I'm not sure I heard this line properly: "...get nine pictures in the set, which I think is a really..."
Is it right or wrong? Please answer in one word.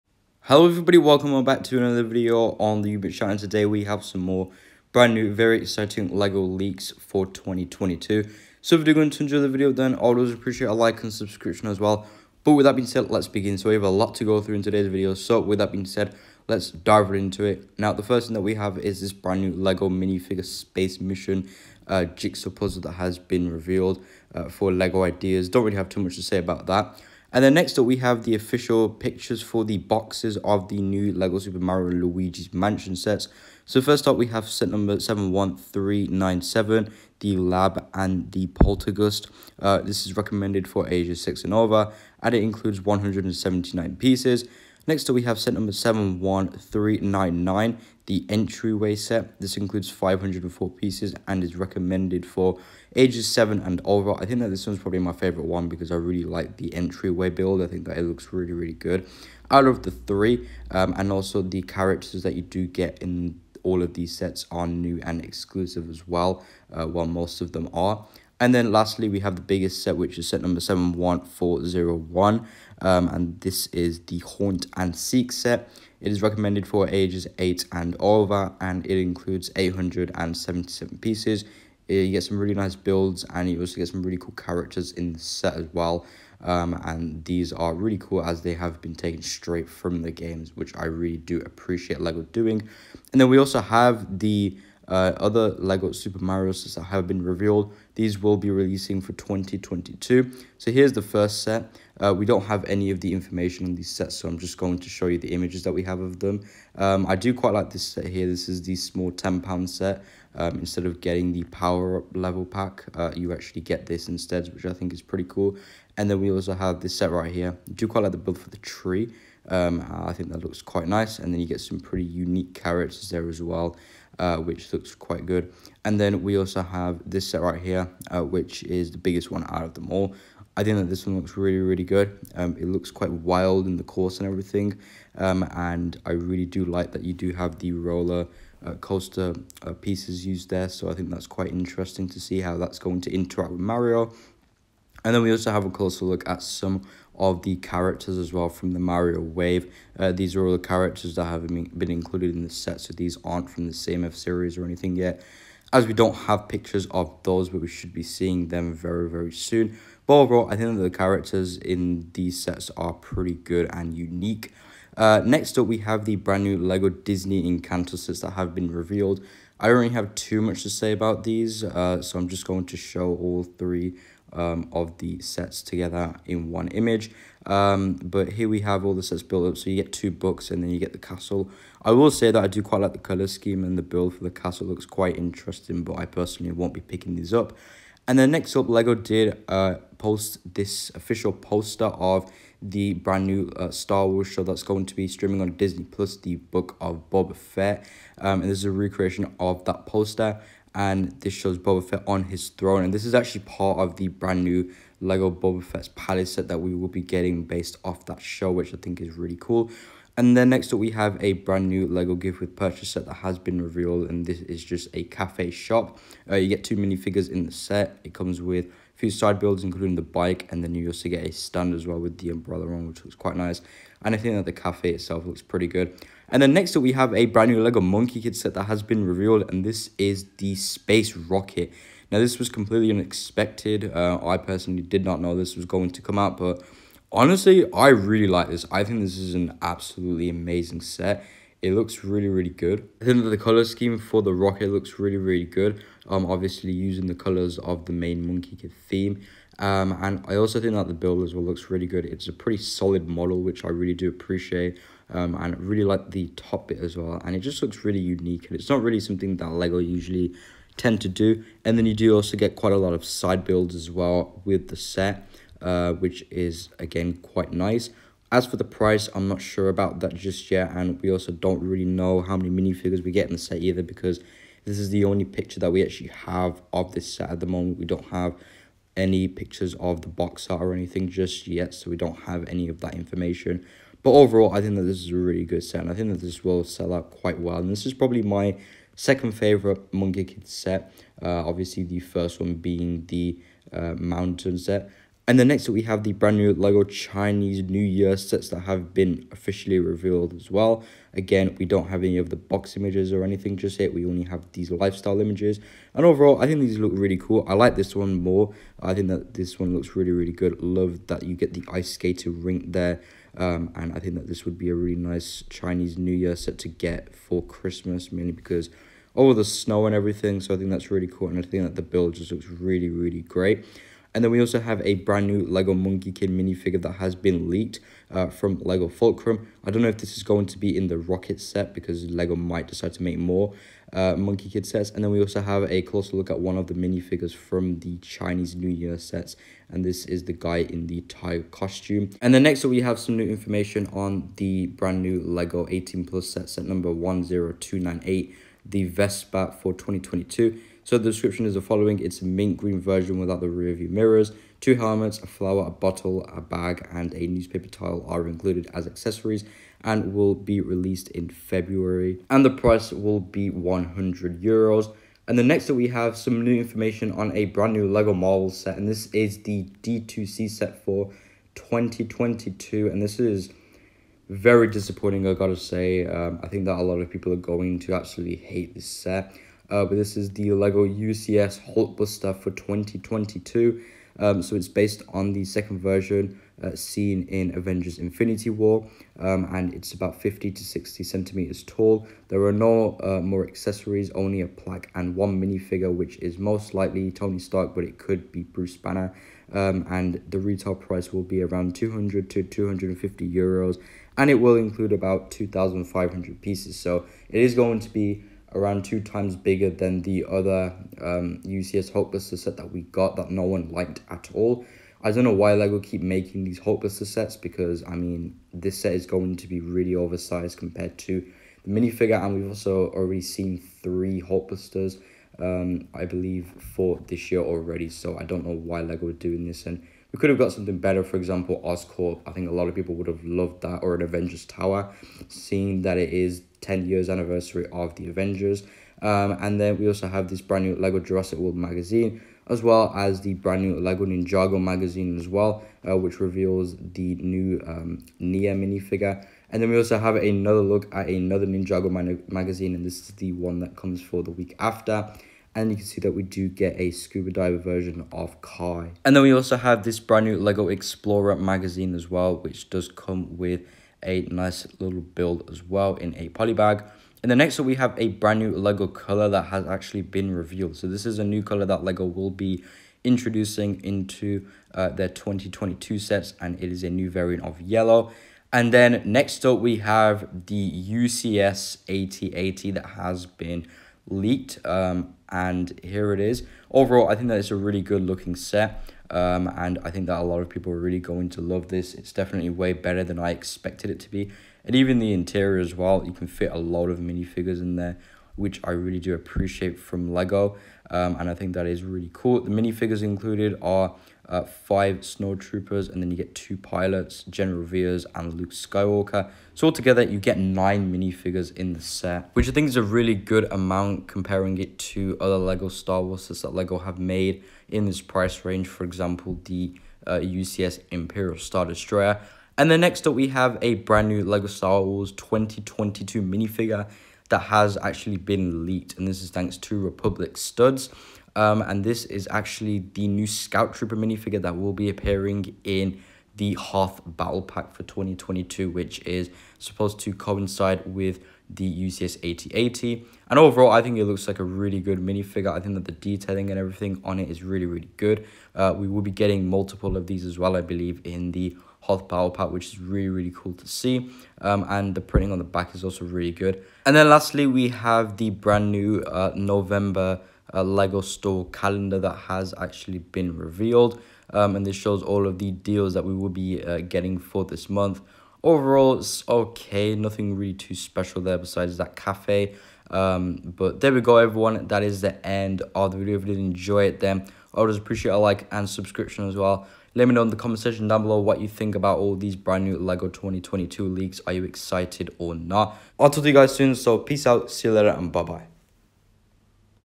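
wrong.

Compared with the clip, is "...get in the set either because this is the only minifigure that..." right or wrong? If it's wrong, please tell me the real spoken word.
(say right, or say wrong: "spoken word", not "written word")
wrong: "picture", not "minifigure".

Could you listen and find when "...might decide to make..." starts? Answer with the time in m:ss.
5:32.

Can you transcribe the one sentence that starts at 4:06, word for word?
Um, obviously using the colors of the main Monkie Kid theme.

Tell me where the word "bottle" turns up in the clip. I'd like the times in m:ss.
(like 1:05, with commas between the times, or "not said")
5:55.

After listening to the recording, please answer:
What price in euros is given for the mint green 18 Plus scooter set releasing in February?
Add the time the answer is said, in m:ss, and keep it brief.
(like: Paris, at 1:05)
100 euros, at 6:03.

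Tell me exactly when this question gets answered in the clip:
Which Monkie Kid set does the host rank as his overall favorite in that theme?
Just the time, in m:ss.
4:53.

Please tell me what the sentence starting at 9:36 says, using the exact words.
If you did enjoy it, then I would just appreciate a like and subscription as well.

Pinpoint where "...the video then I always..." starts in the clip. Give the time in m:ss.
0:09.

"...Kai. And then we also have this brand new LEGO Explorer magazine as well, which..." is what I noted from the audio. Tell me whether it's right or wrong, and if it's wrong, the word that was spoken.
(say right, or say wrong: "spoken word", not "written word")
right.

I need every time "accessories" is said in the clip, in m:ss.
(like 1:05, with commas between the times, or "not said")
5:58, 6:33.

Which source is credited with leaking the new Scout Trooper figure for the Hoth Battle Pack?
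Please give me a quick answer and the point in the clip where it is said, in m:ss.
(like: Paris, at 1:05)
Republic Studs, at 8:49.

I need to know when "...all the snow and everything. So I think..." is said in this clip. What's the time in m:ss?
5:19.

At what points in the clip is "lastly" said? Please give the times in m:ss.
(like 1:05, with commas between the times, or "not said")
1:08, 9:17.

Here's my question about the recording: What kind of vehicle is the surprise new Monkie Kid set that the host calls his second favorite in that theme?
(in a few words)
Space Rocket.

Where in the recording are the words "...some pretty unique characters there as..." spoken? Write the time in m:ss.
2:01.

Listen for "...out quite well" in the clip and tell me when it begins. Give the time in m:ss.
4:46.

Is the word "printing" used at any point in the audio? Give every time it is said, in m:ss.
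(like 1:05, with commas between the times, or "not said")
9:15.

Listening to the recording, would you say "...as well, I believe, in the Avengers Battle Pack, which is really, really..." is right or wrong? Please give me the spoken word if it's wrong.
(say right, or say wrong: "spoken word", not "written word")
wrong: "Hoth", not "Avengers".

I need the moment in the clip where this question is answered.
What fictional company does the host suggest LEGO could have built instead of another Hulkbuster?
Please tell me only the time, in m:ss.
7:11.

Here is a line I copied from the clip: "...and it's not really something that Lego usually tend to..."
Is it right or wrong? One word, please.
right.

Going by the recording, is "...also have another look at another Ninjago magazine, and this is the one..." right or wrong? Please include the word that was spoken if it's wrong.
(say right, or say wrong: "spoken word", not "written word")
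right.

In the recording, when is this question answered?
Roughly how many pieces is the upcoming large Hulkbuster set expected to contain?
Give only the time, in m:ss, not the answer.
6:45.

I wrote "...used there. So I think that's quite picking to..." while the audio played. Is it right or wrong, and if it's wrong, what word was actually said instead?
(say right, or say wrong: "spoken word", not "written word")
wrong: "interesting", not "picking".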